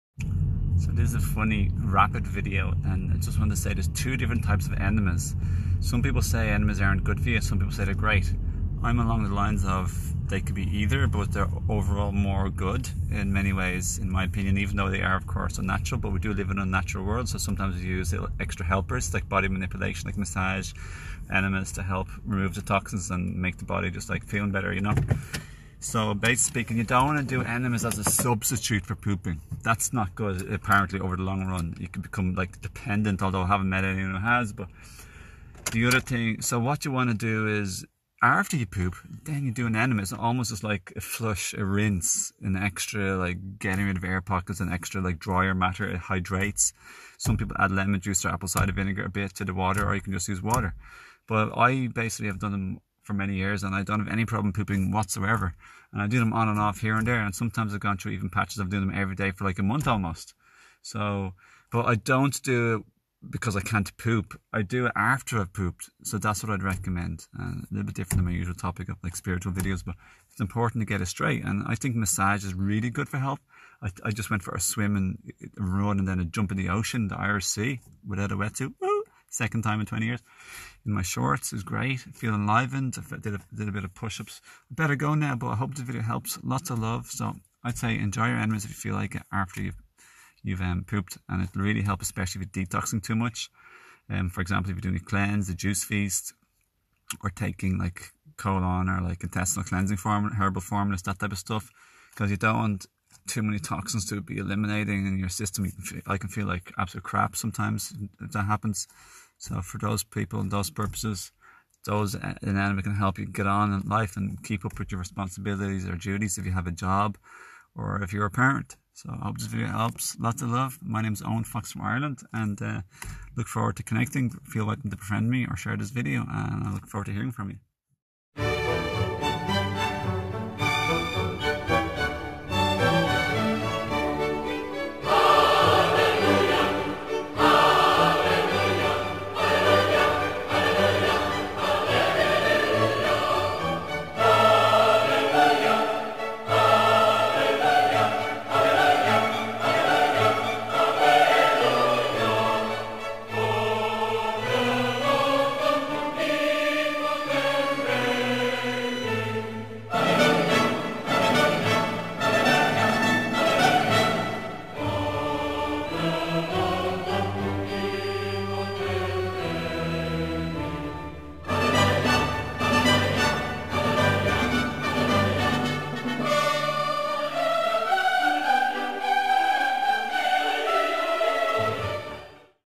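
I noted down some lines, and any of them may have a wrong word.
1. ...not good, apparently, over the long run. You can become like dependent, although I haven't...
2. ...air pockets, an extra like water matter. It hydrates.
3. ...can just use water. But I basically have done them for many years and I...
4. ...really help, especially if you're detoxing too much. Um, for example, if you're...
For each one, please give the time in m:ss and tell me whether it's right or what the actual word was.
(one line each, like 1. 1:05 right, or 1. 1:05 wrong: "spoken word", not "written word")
1. 0:29 right
2. 0:44 wrong: "drier", not "water"
3. 0:50 right
4. 1:31 right.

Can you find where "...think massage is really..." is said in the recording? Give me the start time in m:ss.
1:11.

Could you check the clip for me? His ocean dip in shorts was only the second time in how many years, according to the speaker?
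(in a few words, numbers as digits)
20.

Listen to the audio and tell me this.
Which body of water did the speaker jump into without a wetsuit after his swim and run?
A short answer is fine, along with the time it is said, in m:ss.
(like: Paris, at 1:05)
The Irish Sea, at 1:17.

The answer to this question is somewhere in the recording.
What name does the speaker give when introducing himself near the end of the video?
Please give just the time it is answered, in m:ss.
2:01.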